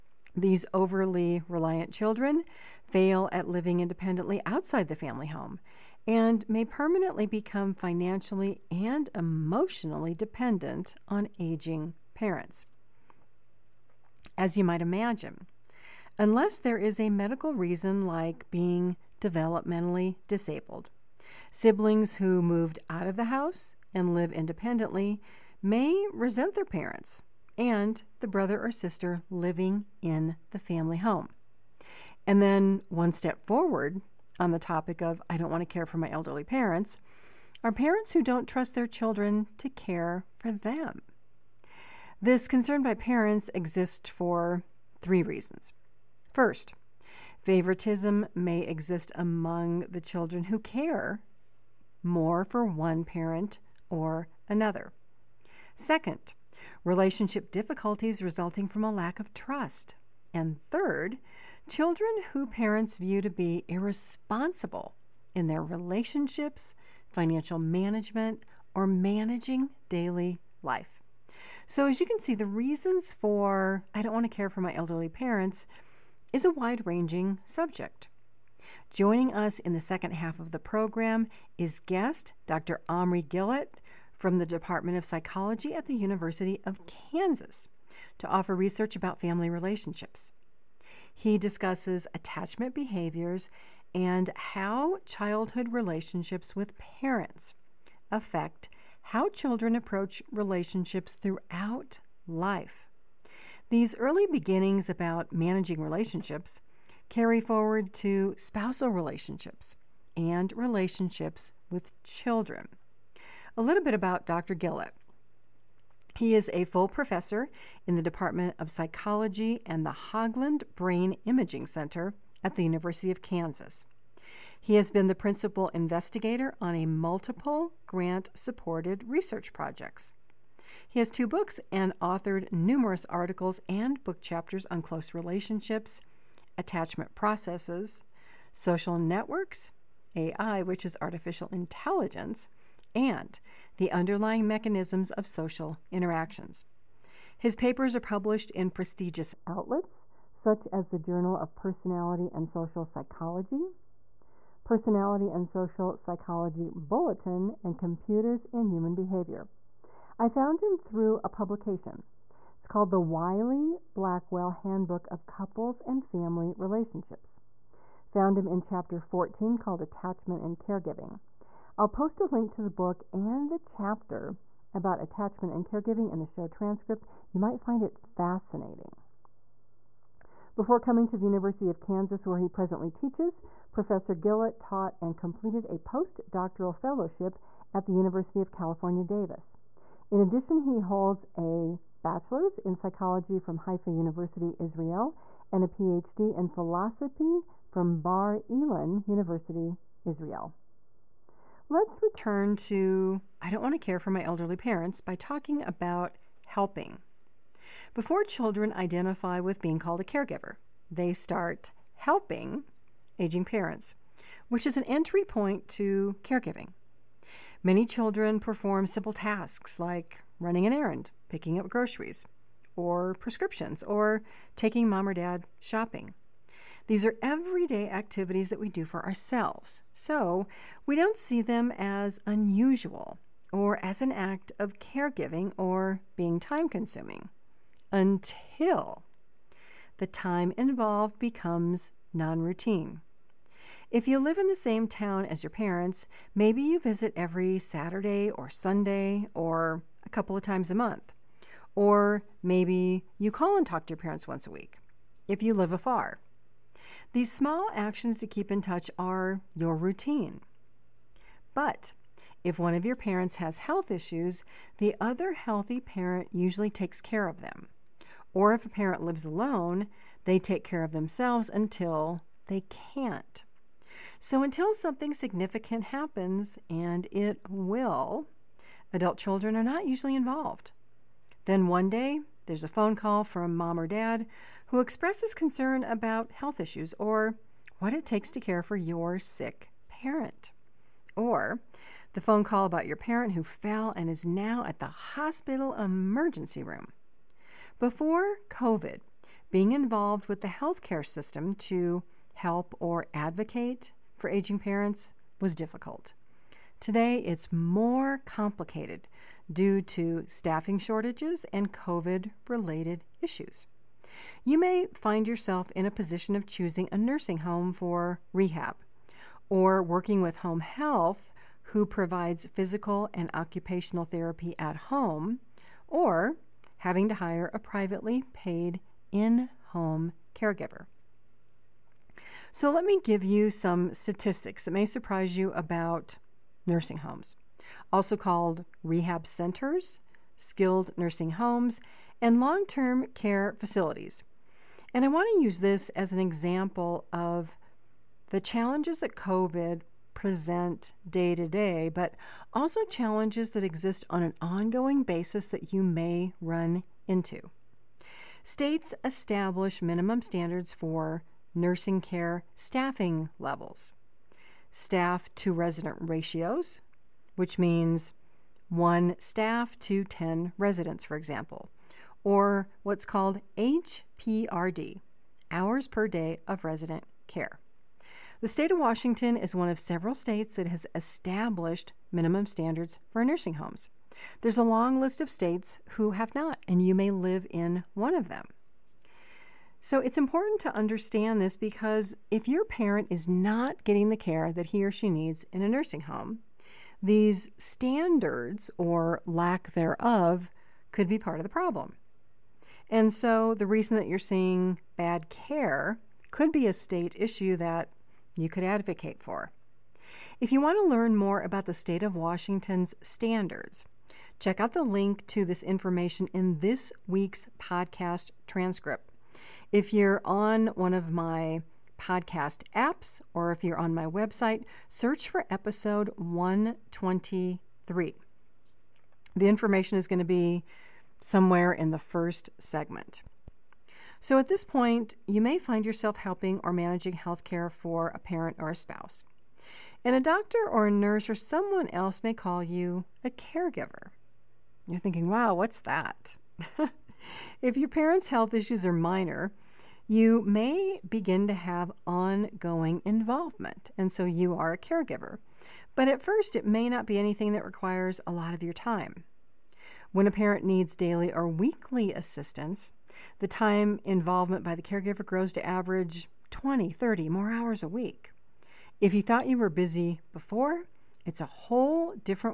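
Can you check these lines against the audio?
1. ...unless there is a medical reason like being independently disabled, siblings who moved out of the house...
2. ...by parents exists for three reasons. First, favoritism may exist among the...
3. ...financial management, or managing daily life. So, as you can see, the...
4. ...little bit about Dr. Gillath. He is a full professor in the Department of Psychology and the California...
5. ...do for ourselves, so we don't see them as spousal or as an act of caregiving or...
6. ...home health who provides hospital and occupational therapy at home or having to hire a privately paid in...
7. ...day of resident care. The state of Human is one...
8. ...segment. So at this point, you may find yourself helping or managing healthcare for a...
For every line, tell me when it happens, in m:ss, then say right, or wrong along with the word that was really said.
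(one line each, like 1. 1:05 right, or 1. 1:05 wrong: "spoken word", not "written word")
1. 0:16 wrong: "developmentally", not "independently"
2. 0:42 right
3. 1:07 right
4. 1:53 wrong: "Hoglund", not "California"
5. 3:48 wrong: "unusual", not "spousal"
6. 5:20 wrong: "physical", not "hospital"
7. 6:16 wrong: "Washington", not "Human"
8. 7:12 right.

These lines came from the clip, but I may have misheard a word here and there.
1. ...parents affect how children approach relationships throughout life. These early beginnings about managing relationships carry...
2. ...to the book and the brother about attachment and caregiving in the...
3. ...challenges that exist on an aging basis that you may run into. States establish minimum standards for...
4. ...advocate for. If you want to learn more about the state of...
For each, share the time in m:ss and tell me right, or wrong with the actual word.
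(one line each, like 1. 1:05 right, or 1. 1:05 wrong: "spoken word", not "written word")
1. 1:36 right
2. 2:52 wrong: "chapter", not "brother"
3. 5:52 wrong: "ongoing", not "aging"
4. 6:48 right.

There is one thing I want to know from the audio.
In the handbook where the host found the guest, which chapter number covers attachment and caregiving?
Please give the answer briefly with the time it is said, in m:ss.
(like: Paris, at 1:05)
14, at 2:48.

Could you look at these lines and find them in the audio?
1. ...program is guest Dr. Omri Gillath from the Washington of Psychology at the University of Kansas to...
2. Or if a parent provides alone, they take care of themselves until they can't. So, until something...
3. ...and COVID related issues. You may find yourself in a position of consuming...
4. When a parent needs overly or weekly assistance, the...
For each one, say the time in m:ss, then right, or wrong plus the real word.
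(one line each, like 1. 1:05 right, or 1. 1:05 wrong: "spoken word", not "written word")
1. 1:20 wrong: "Department", not "Washington"
2. 4:28 wrong: "lives", not "provides"
3. 5:11 wrong: "choosing", not "consuming"
4. 7:40 wrong: "daily", not "overly".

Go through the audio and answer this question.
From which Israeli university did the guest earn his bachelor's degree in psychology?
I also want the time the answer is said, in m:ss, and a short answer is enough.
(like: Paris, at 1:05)
Haifa University, at 3:13.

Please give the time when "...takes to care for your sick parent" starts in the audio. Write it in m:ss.
4:48.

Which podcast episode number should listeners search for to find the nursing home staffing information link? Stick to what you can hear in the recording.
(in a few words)
123.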